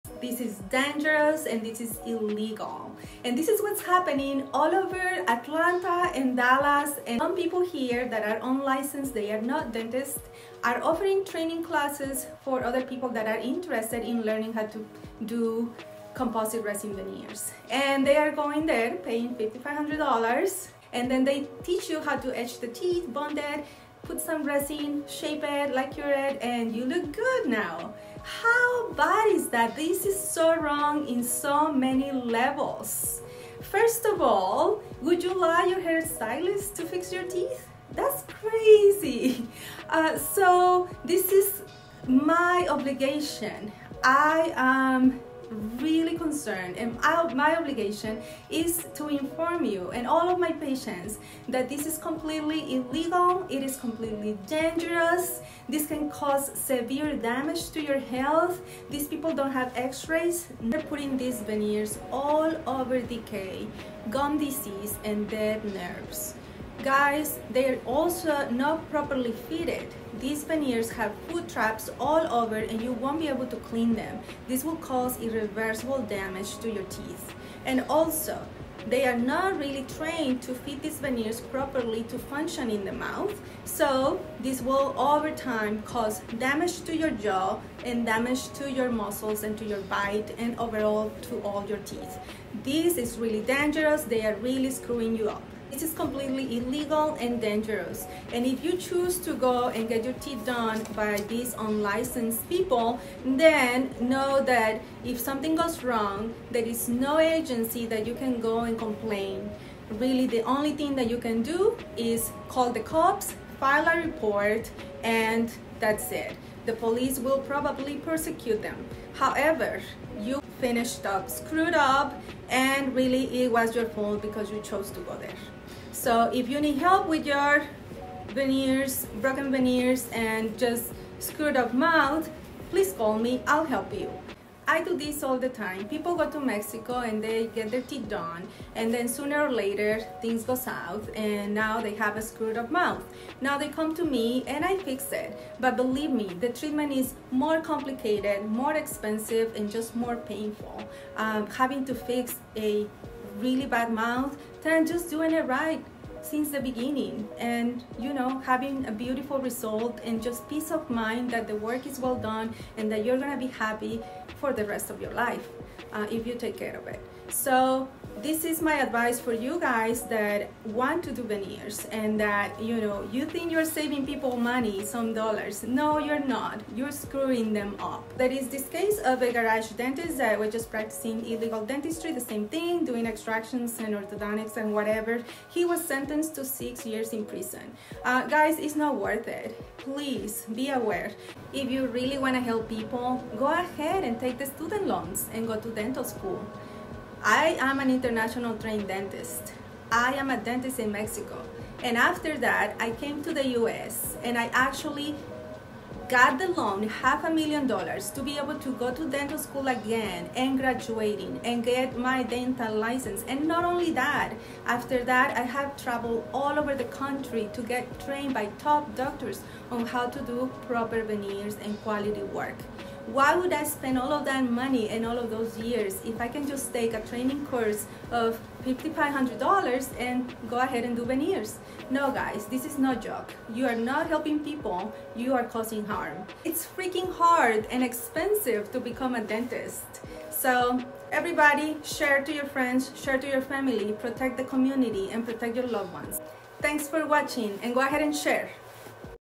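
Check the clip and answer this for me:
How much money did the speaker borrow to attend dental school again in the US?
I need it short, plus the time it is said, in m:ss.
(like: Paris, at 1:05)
half a million dollars, at 3:26.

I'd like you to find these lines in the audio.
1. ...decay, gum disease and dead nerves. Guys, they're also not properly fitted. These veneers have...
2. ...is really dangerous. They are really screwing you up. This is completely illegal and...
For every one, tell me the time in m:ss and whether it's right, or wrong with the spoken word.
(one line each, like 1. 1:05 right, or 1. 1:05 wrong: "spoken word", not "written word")
1. 1:02 right
2. 1:32 right.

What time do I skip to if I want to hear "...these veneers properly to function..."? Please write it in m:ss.
1:20.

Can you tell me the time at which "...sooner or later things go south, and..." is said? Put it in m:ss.
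2:19.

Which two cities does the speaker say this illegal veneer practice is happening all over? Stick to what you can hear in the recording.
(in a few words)
Atlanta and Dallas.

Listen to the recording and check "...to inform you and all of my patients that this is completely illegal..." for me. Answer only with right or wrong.
right.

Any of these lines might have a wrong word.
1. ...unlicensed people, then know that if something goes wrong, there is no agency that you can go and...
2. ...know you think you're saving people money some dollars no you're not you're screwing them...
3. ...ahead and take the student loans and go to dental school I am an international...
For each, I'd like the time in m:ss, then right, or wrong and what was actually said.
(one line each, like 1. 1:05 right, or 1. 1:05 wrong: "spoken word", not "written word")
1. 1:41 right
2. 2:52 right
3. 3:13 right.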